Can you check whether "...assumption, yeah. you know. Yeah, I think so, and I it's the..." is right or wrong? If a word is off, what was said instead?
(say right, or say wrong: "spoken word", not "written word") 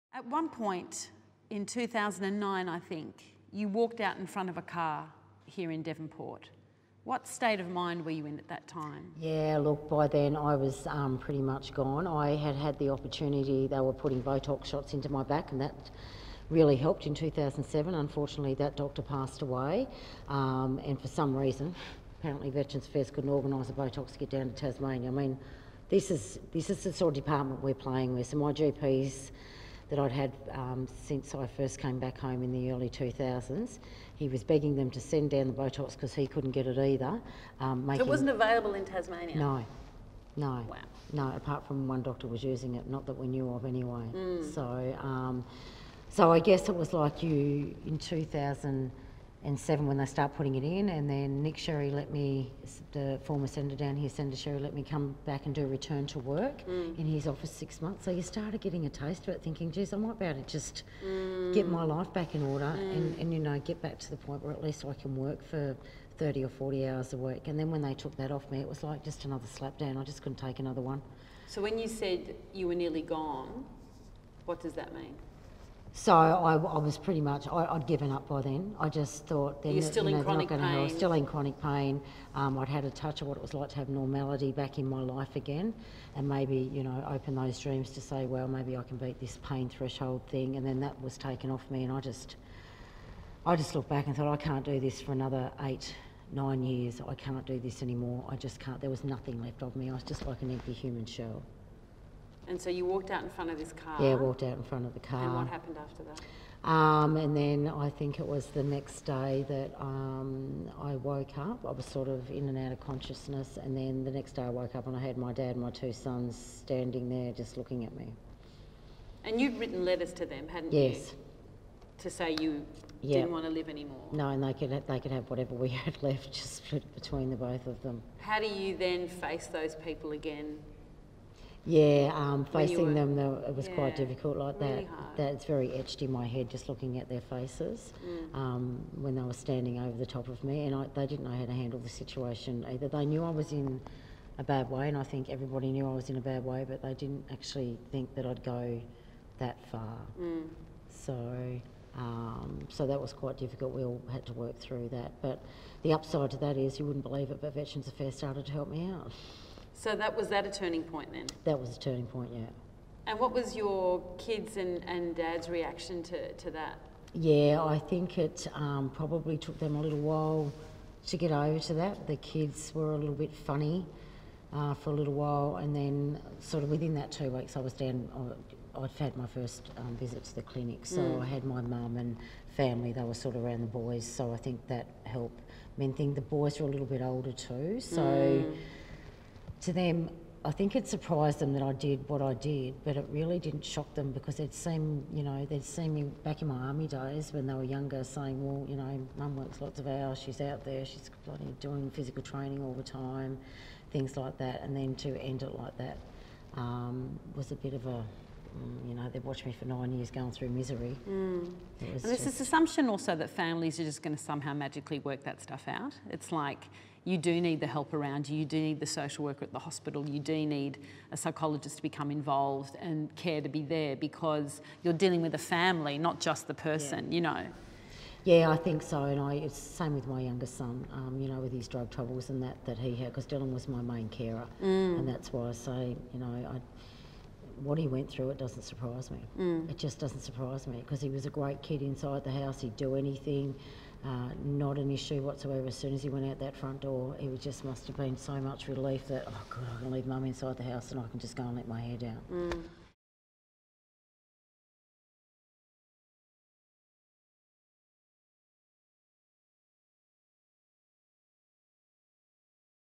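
wrong: "person", not "assumption".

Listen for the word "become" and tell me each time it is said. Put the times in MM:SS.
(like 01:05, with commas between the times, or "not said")
03:41.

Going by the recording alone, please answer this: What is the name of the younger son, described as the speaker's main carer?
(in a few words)
Dylan.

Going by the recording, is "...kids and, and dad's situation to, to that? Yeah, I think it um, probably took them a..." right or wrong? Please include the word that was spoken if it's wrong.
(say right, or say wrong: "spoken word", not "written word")
wrong: "reaction", not "situation".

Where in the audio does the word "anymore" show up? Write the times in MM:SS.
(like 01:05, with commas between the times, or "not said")
01:37, 02:03.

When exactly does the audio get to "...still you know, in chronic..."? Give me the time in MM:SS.
01:19.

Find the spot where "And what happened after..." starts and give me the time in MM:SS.
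01:45.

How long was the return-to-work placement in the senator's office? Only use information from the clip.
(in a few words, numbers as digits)
6 months.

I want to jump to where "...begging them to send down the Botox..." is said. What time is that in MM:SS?
00:34.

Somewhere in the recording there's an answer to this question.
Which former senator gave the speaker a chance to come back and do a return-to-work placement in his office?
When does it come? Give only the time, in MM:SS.
00:51.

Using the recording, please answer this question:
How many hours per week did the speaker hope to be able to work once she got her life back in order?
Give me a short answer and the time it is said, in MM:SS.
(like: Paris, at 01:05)
30 or 40, at 01:06.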